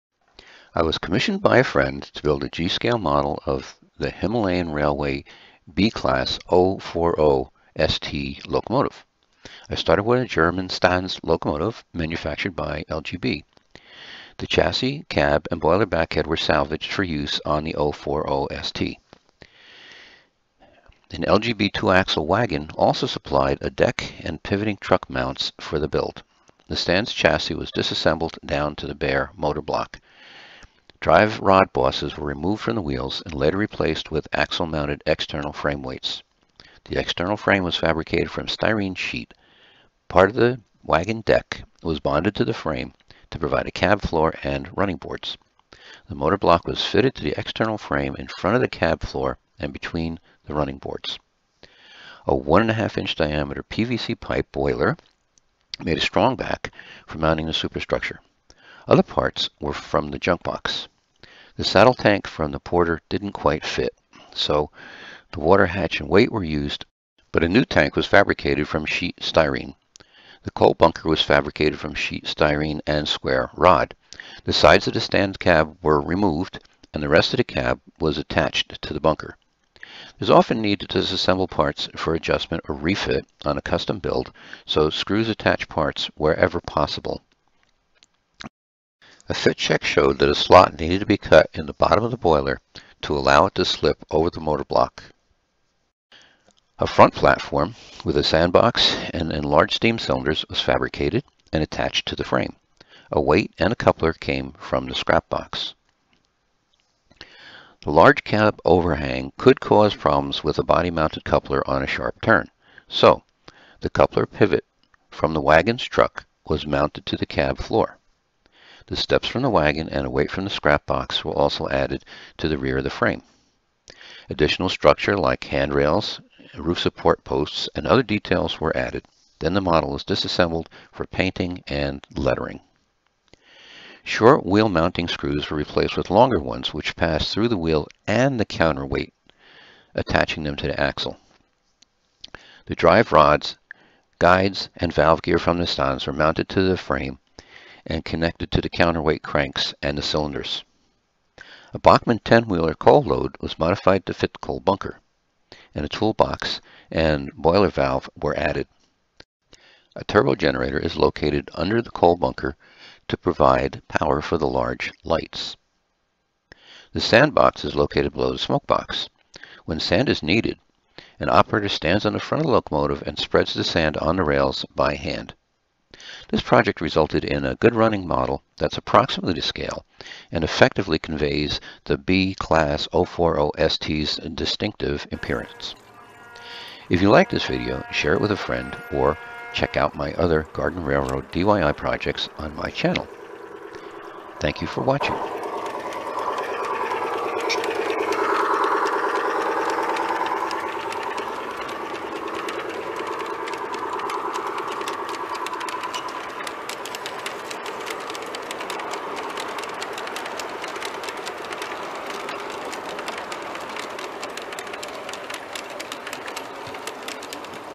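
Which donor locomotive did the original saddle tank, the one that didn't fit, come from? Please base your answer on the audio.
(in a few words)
Porter.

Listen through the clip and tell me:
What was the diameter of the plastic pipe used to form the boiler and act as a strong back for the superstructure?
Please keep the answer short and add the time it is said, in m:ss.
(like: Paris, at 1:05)
1.5 inch, at 0:52.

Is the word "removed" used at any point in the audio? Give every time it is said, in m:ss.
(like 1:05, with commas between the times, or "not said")
0:32, 1:15.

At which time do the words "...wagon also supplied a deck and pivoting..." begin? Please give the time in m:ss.
0:22.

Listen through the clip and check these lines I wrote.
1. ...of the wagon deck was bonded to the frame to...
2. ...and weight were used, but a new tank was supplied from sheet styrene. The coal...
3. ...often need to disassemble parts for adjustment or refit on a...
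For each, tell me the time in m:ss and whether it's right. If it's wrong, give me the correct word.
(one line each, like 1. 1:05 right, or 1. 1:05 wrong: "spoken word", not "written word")
1. 0:40 right
2. 1:05 wrong: "fabricated", not "supplied"
3. 1:20 right.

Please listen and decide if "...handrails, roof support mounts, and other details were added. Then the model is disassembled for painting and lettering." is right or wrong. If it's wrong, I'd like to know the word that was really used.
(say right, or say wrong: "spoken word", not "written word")
wrong: "posts", not "mounts".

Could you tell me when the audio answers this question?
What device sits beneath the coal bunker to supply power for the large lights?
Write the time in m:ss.
2:40.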